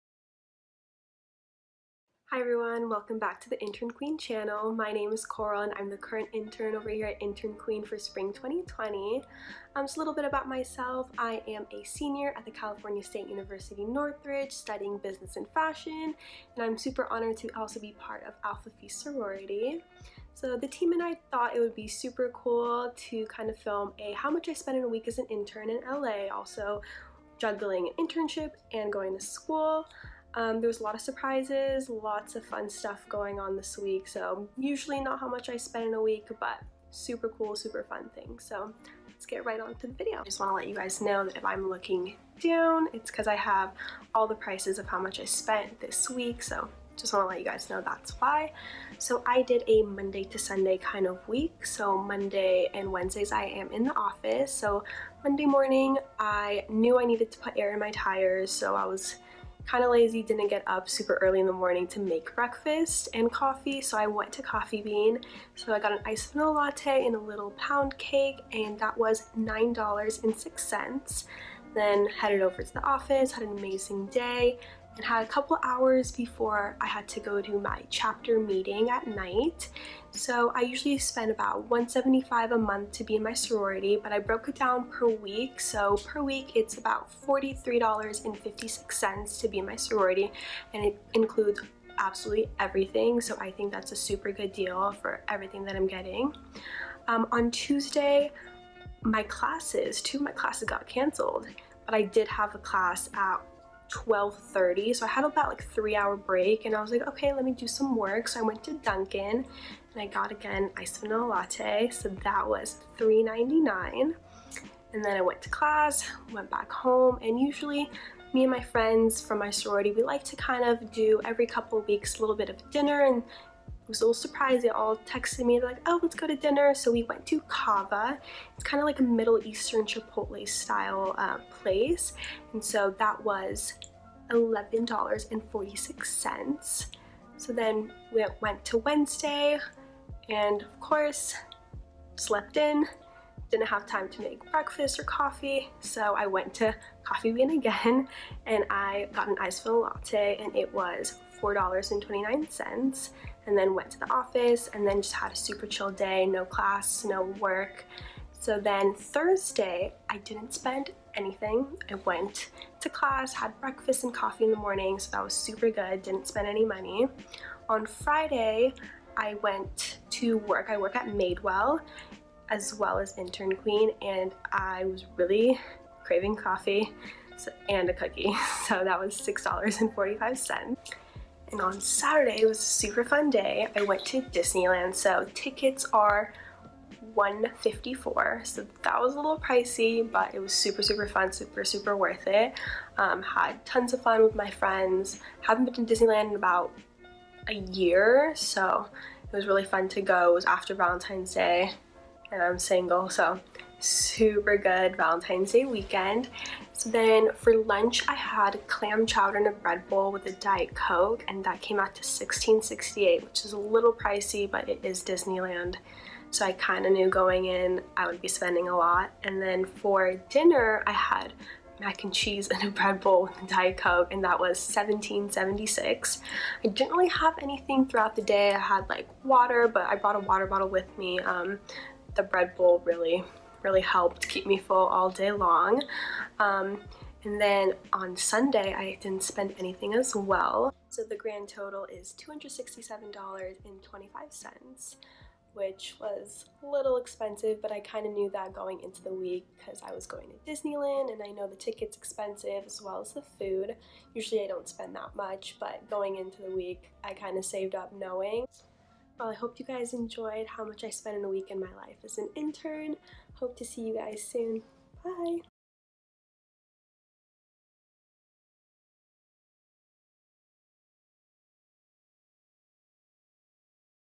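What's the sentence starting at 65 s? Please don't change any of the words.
So I got an iced vanilla latte and a little pound cake, and that was $9.06.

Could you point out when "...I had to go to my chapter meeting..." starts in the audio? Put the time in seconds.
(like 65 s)
76 s.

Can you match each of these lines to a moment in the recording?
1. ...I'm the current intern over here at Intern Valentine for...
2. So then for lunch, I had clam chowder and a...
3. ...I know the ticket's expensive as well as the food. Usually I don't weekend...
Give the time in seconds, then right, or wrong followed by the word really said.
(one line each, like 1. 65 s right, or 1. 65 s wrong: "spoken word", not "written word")
1. 5 s wrong: "Queen", not "Valentine"
2. 206 s right
3. 251 s wrong: "spend", not "weekend".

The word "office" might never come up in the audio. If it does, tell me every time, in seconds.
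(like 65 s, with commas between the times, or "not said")
53 s, 72 s, 154 s.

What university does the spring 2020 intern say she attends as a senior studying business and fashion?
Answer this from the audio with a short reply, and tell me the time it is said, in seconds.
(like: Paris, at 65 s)
California State University Northridge, at 12 s.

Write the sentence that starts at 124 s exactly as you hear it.
They all texted me, they're like, oh, let's go to dinner.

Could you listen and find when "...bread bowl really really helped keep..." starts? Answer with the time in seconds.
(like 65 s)
232 s.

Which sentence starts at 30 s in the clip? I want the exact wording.
Um, there was a lot of surprises, lots of fun stuff going on this week.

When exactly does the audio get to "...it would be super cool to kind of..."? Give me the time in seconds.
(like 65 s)
21 s.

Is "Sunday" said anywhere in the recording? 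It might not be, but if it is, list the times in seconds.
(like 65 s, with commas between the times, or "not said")
50 s, 238 s.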